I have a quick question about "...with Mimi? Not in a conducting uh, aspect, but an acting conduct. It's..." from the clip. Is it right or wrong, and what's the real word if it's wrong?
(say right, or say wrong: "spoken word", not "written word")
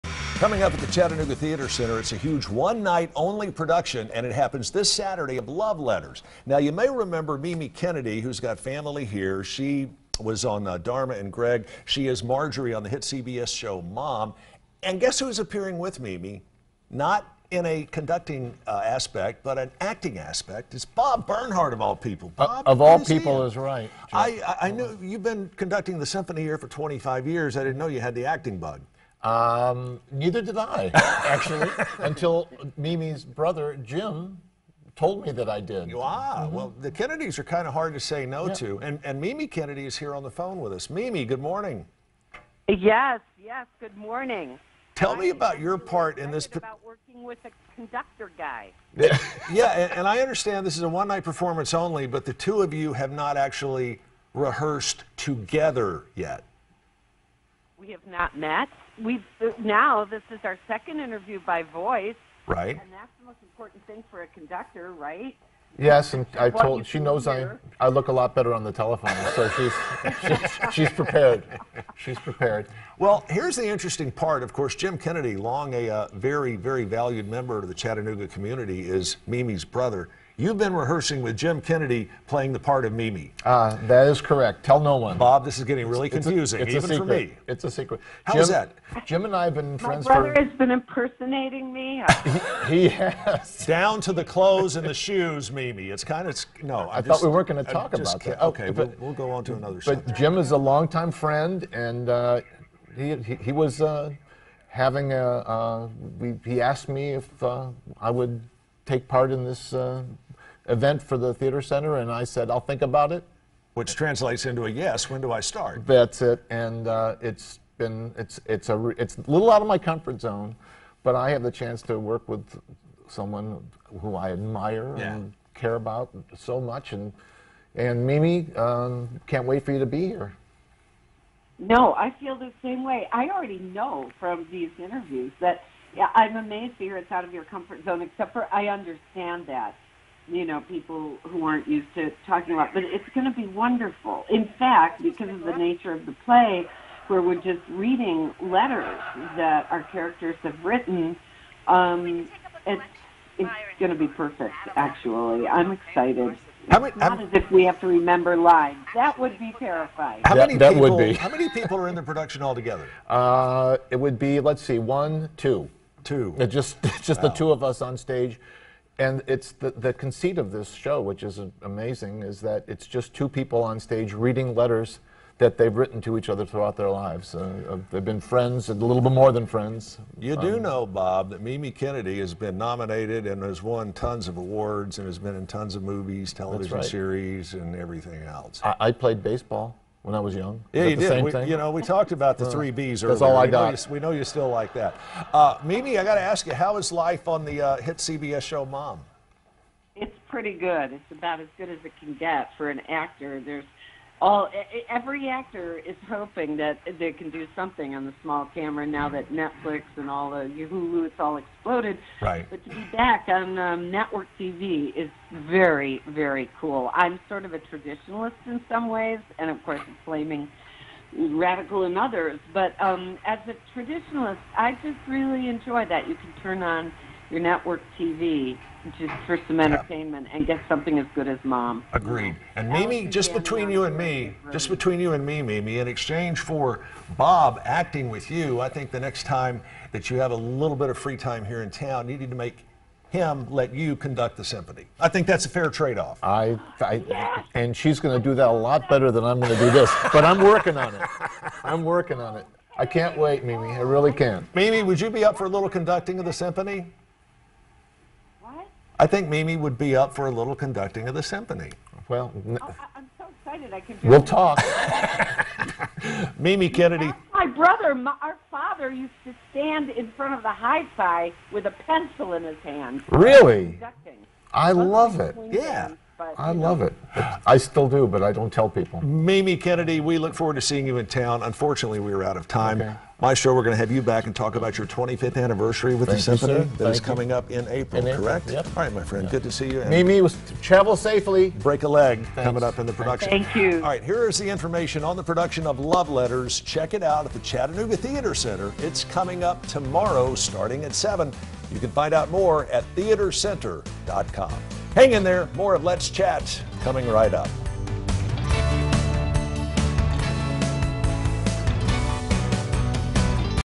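wrong: "aspect", not "conduct".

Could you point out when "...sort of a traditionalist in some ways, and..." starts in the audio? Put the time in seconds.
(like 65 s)
217 s.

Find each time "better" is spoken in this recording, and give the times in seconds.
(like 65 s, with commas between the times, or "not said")
68 s, 248 s.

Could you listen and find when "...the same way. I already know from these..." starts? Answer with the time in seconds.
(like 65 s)
132 s.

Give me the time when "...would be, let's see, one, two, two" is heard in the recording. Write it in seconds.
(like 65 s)
163 s.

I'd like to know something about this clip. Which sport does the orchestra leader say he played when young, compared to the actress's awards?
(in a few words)
Baseball.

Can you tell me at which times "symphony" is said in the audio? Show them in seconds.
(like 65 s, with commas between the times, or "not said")
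26 s, 244 s, 256 s, 261 s, 286 s.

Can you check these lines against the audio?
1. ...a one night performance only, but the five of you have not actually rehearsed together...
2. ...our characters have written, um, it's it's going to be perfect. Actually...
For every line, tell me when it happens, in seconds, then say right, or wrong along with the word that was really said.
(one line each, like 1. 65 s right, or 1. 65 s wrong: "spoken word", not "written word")
1. 50 s wrong: "two", not "five"
2. 149 s right.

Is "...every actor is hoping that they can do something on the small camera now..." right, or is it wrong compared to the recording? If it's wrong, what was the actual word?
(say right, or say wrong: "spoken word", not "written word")
right.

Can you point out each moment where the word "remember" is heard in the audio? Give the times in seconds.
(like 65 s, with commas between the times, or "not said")
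6 s, 157 s.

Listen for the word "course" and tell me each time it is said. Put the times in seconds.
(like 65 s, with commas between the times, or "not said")
74 s, 219 s.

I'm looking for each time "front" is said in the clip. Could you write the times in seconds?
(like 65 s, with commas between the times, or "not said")
270 s.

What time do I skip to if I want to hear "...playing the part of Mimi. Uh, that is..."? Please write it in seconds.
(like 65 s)
82 s.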